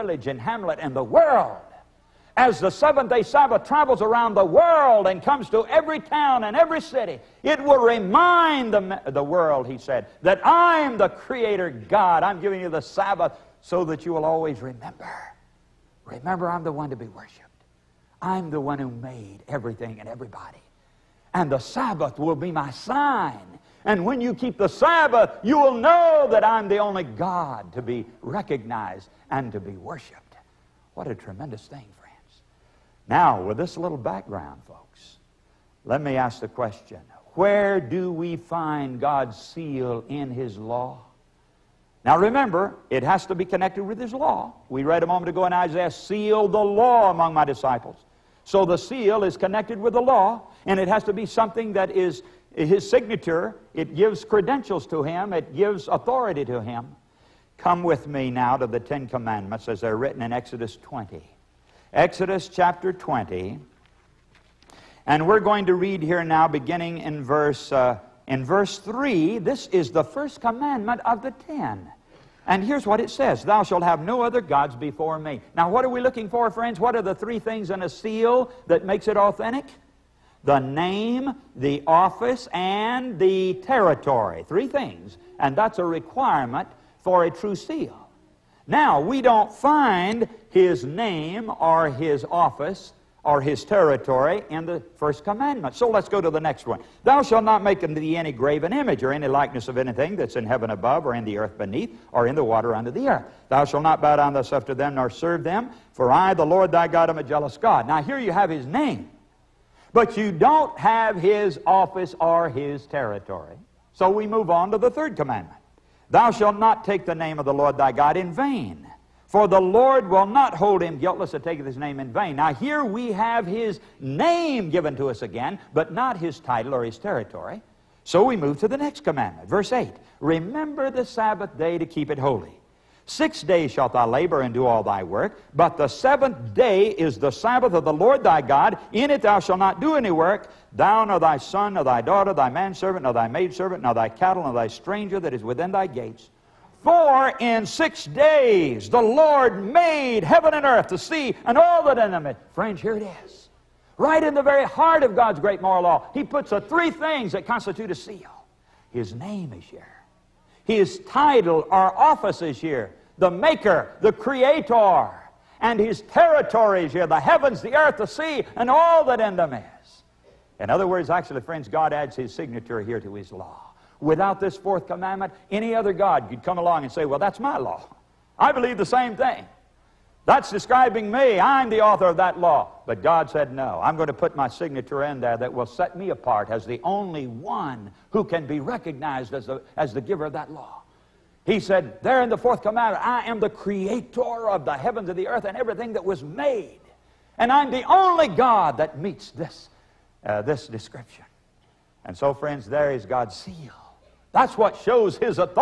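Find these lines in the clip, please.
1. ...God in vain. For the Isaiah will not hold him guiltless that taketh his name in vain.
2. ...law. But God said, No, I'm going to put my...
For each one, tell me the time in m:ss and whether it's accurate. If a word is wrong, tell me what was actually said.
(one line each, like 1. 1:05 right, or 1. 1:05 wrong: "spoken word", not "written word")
1. 1:57 wrong: "Lord", not "Isaiah"
2. 3:02 right.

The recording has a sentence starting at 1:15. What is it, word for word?
Now, what are we looking for, friends?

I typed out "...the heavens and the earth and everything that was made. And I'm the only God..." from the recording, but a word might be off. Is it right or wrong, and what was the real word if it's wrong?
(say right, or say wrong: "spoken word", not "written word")
right.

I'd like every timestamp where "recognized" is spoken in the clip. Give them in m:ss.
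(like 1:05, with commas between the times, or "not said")
0:28, 3:08.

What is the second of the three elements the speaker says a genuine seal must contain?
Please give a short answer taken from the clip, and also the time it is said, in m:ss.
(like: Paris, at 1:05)
The office, at 1:21.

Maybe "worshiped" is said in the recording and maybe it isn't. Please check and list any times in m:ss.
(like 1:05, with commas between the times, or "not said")
0:17, 0:29.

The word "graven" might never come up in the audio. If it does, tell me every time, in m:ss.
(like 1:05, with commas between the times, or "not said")
1:38.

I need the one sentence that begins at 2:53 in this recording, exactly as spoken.
Without this fourth commandment, any other God could come along and say, Well, that's my law.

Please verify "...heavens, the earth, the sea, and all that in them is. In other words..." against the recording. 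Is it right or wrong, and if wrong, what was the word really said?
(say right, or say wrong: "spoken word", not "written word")
right.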